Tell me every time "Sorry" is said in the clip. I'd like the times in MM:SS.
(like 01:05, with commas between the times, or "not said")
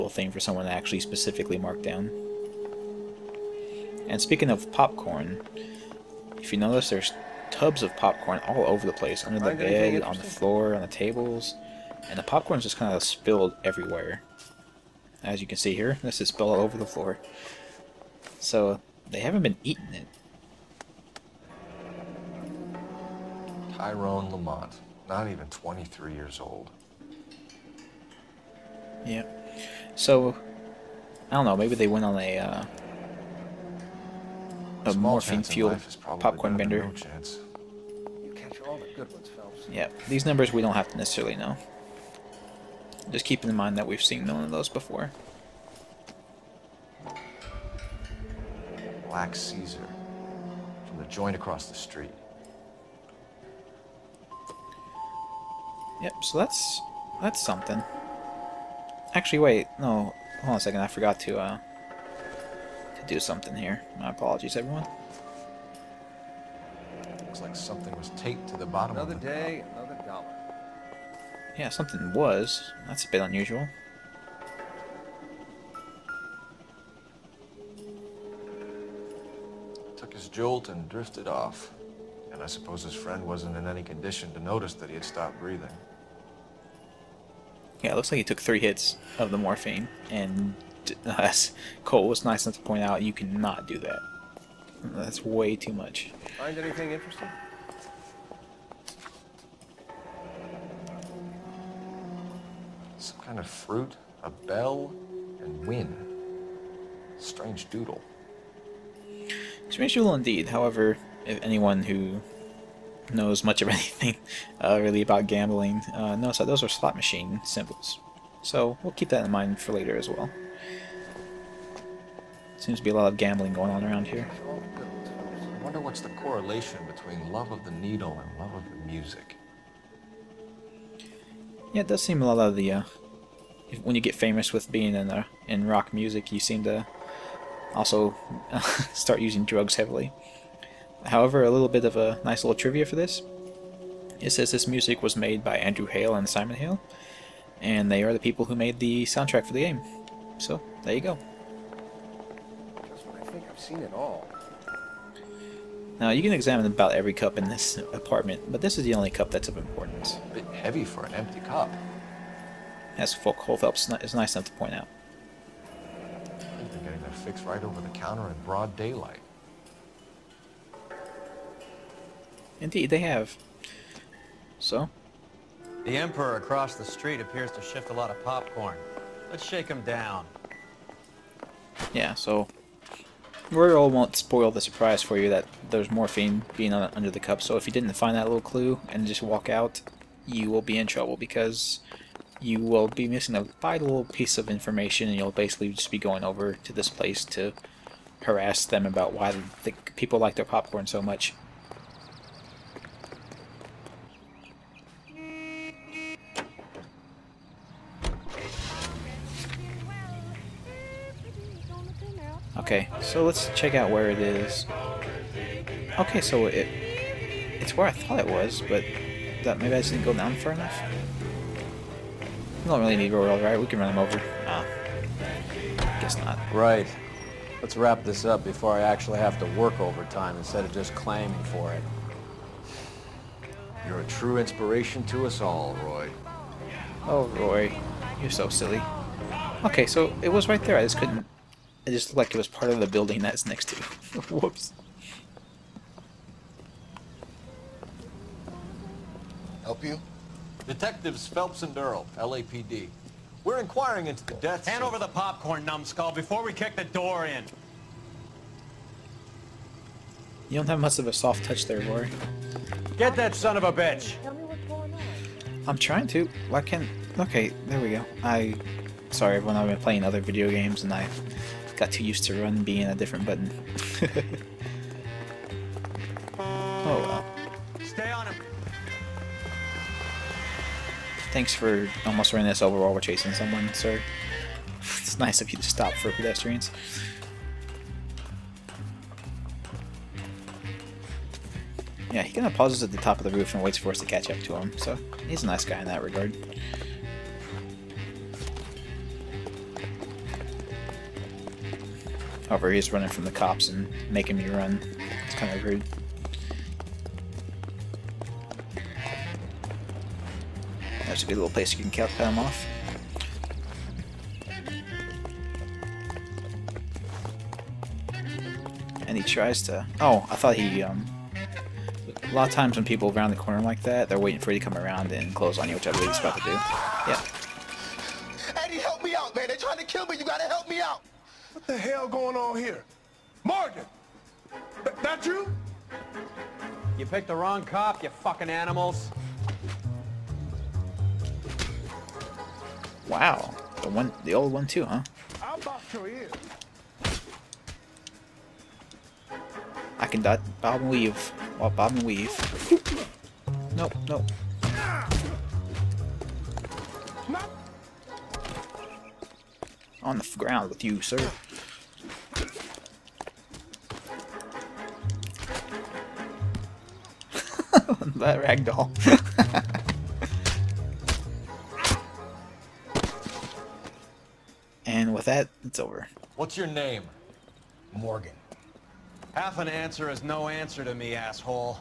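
04:29.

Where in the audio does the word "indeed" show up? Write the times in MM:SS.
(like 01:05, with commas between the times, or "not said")
01:50, 02:52.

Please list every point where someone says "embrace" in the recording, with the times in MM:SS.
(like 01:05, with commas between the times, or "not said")
not said.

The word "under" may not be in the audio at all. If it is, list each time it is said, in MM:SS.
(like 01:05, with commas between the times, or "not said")
00:09, 03:06.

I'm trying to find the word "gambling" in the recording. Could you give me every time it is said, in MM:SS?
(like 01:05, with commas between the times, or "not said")
01:55, 02:03.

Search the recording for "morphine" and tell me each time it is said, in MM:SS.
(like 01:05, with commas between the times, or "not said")
00:34, 01:29, 03:05.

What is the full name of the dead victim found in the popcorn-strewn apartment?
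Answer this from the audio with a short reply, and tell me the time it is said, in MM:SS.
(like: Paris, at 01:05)
Tyrone Lamont, at 00:23.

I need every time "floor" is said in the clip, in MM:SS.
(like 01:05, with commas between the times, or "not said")
00:10, 00:16.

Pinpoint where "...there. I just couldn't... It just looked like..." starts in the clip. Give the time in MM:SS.
04:00.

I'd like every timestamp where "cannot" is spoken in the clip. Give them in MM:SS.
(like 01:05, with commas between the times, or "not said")
01:33.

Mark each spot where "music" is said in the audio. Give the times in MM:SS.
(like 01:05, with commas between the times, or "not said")
02:08, 02:15, 02:24.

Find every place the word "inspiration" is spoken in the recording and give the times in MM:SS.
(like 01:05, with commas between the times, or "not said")
03:54.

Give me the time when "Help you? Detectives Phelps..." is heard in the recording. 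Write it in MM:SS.
04:09.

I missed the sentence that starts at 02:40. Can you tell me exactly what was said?
A bit heavy for an empty cup as Phelps is nice enough to point out.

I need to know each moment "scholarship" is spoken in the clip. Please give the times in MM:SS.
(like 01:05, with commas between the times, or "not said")
not said.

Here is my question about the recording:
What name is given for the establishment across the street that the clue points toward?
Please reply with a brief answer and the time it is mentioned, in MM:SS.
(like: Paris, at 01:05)
Black Caesar, at 00:49.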